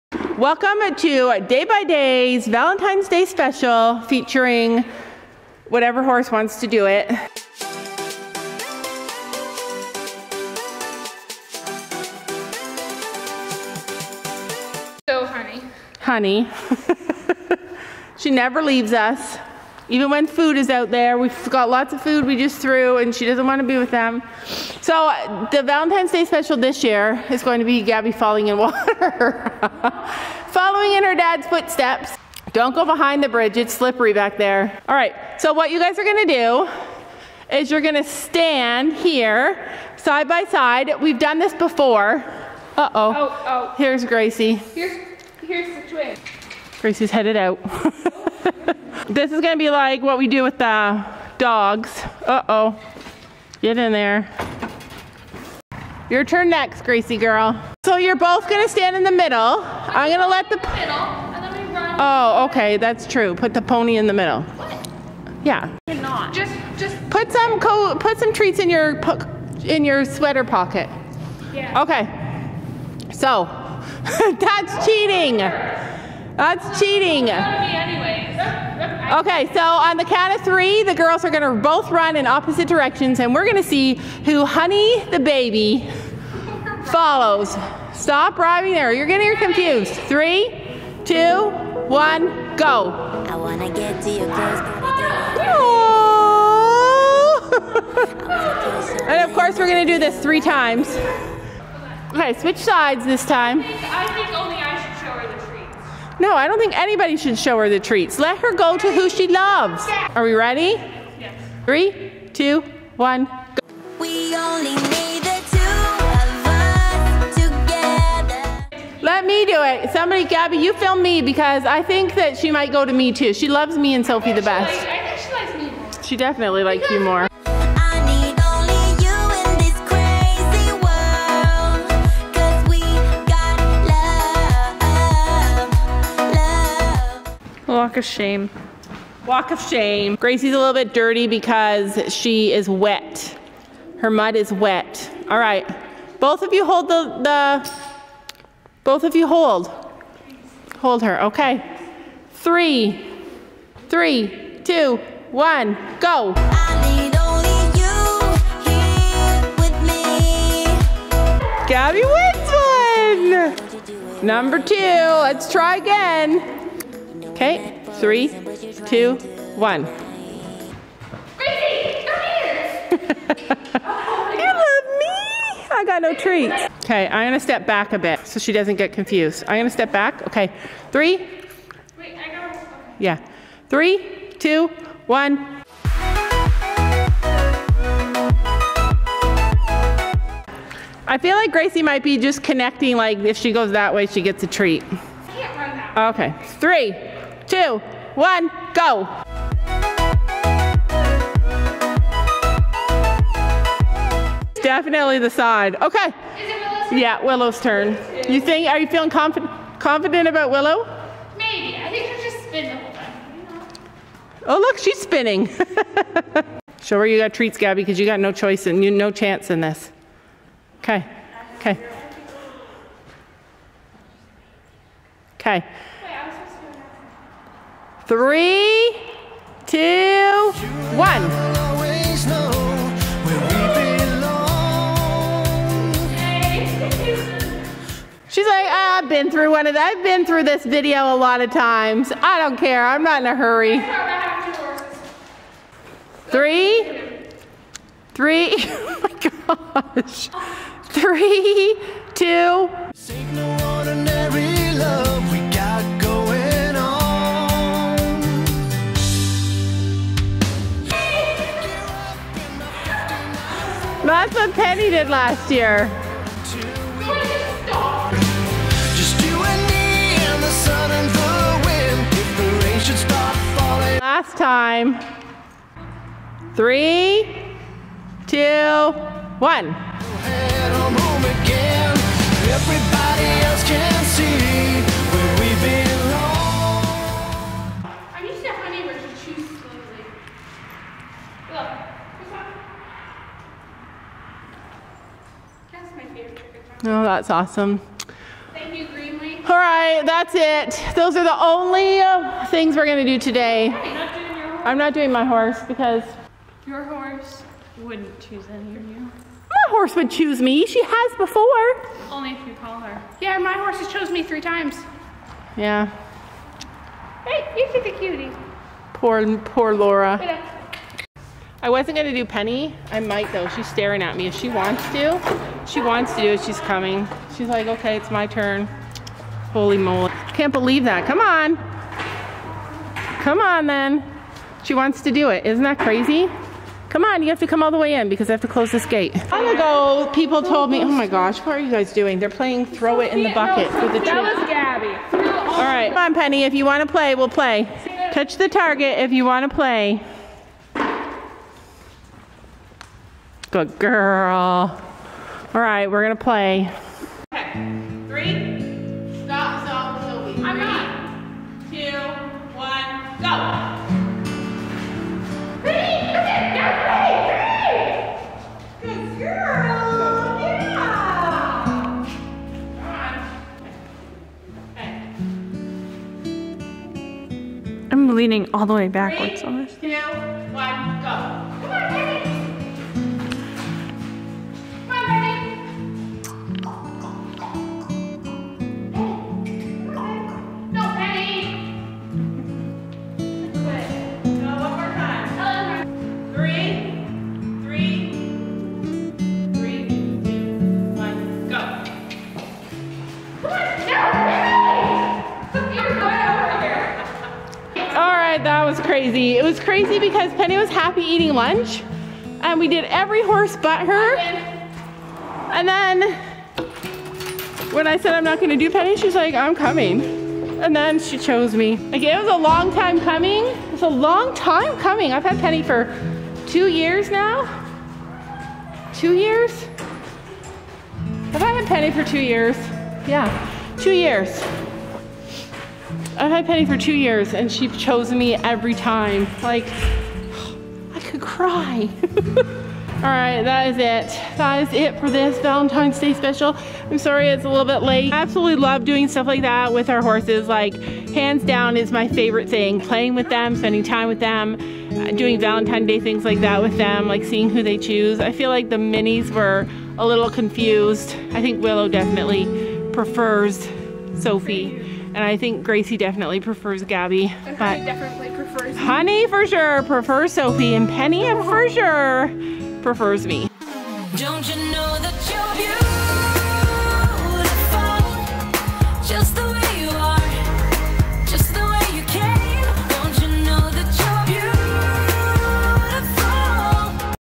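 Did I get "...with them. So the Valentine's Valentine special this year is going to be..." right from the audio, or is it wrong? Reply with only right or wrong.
wrong.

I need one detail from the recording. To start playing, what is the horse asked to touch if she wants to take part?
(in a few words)
The target.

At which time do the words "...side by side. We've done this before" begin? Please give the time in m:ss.
0:39.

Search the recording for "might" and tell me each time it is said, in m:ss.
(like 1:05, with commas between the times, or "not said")
2:02, 3:11, 5:22.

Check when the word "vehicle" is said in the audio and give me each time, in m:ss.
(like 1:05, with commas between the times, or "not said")
not said.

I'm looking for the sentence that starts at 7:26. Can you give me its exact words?
I'm sorry it's a little bit late.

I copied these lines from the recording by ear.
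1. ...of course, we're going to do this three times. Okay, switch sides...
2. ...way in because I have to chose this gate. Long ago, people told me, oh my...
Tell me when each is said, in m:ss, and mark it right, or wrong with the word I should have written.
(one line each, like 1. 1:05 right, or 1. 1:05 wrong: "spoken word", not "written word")
1. 1:39 right
2. 5:37 wrong: "close", not "chose".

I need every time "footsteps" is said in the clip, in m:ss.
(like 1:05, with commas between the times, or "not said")
0:31.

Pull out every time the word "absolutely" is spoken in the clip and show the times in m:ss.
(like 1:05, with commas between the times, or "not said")
7:28.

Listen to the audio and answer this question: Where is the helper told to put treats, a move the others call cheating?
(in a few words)
Sweater pocket.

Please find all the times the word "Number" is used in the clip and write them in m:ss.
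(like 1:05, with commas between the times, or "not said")
2:44.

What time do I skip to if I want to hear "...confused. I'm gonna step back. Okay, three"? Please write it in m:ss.
2:58.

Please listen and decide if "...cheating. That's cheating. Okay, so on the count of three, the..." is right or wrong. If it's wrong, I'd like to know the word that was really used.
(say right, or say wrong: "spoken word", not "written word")
right.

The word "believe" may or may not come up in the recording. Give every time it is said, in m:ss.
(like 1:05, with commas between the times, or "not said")
5:30.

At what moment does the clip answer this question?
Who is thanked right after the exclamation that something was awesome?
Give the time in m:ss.
4:58.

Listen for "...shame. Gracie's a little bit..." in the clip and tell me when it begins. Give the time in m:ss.
2:19.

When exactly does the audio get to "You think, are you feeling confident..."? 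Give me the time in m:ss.
3:28.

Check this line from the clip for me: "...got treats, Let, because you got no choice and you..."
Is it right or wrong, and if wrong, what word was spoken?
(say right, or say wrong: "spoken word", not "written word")
wrong: "Gabby", not "Let".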